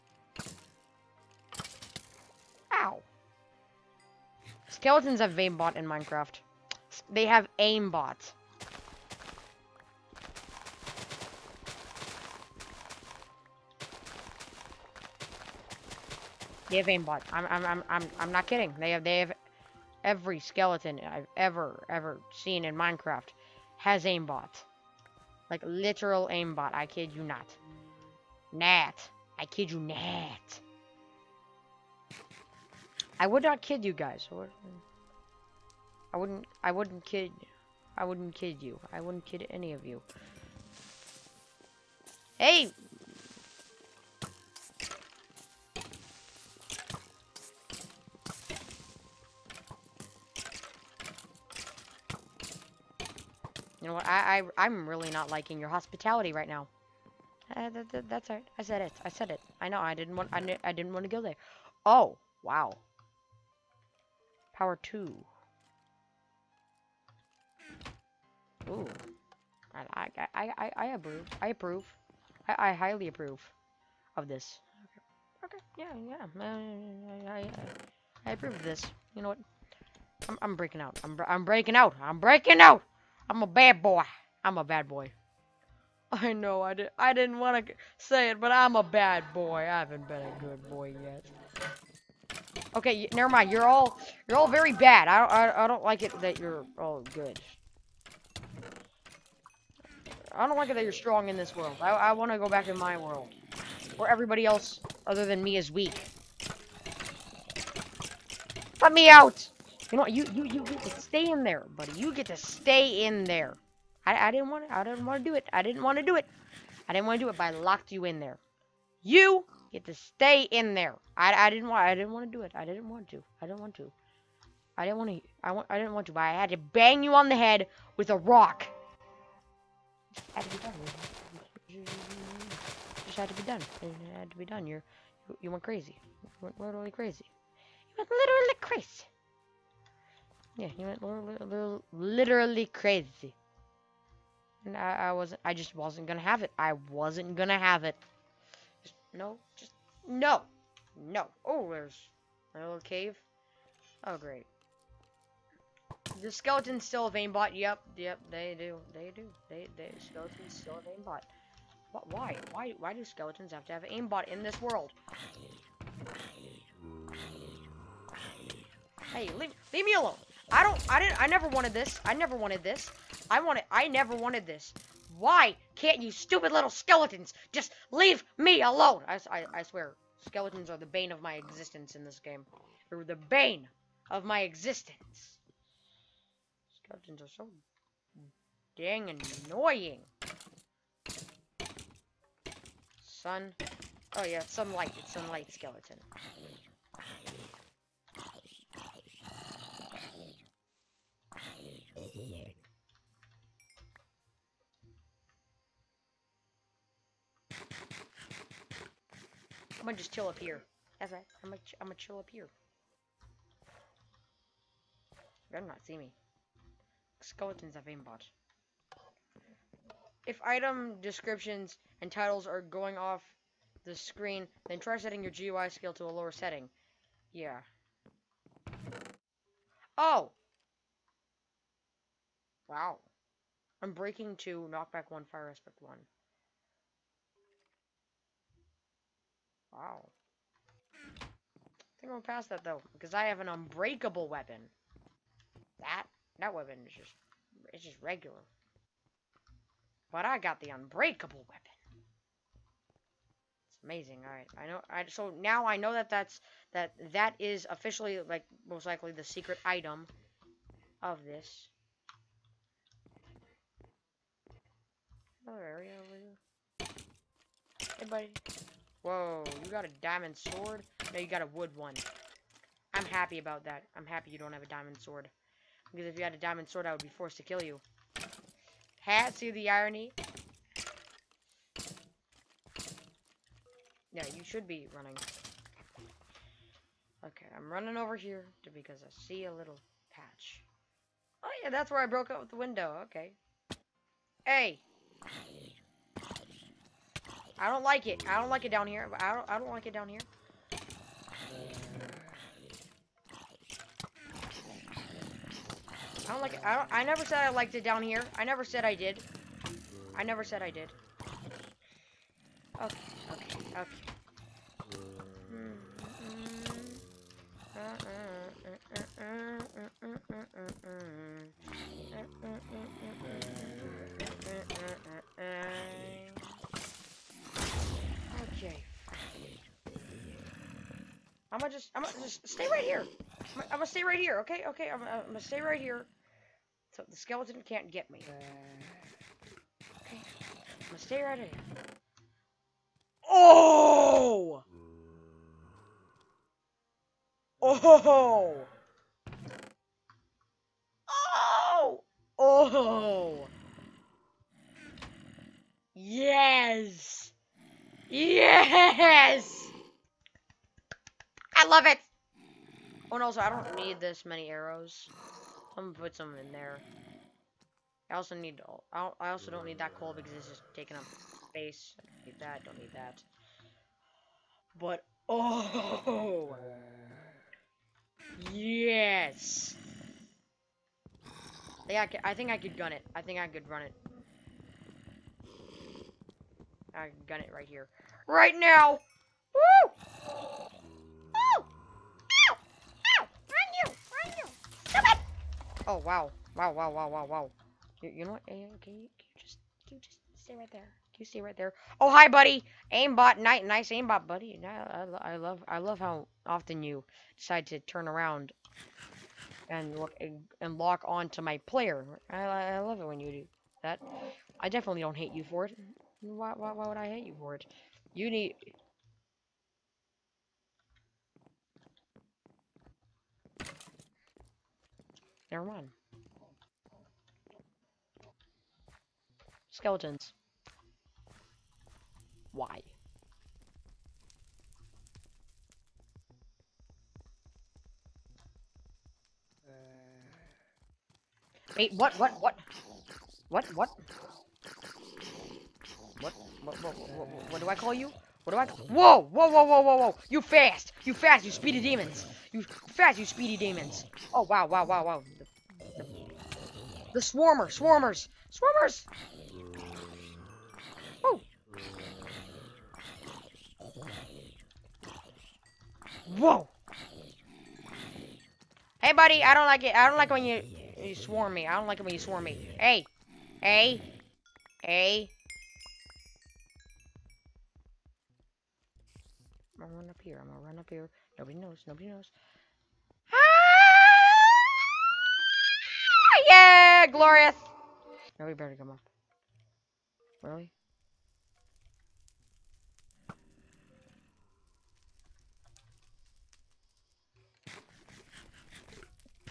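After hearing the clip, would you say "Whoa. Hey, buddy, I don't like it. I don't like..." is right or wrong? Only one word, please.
right.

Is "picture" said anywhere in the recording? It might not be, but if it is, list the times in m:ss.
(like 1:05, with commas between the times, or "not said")
not said.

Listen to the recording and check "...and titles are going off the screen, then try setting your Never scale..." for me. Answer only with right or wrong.
wrong.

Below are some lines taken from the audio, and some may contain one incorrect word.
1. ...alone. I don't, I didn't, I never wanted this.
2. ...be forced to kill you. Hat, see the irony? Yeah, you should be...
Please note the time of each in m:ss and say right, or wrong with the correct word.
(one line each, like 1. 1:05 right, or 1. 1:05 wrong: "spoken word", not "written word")
1. 2:49 right
2. 4:37 right.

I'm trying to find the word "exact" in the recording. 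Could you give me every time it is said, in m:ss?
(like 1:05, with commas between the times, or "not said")
not said.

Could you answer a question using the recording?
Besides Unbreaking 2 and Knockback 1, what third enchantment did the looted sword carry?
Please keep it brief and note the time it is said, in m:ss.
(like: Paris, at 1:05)
Fire Aspect 1, at 3:55.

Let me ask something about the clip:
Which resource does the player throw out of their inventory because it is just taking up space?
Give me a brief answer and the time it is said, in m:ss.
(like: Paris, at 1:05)
coal, at 6:09.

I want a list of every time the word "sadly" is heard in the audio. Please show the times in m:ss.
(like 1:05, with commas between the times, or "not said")
not said.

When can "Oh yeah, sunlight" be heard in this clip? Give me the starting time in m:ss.
3:14.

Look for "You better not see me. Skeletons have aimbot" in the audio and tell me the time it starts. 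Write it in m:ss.
3:35.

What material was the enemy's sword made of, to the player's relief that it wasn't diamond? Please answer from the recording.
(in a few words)
wood.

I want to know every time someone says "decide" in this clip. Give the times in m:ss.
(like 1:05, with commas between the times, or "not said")
6:47.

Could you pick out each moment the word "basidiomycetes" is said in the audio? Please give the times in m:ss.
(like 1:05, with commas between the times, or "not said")
not said.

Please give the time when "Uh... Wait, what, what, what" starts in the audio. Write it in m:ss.
7:19.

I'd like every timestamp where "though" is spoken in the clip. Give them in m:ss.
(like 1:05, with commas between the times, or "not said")
4:02.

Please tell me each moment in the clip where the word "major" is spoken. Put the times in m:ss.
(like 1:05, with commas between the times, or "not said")
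not said.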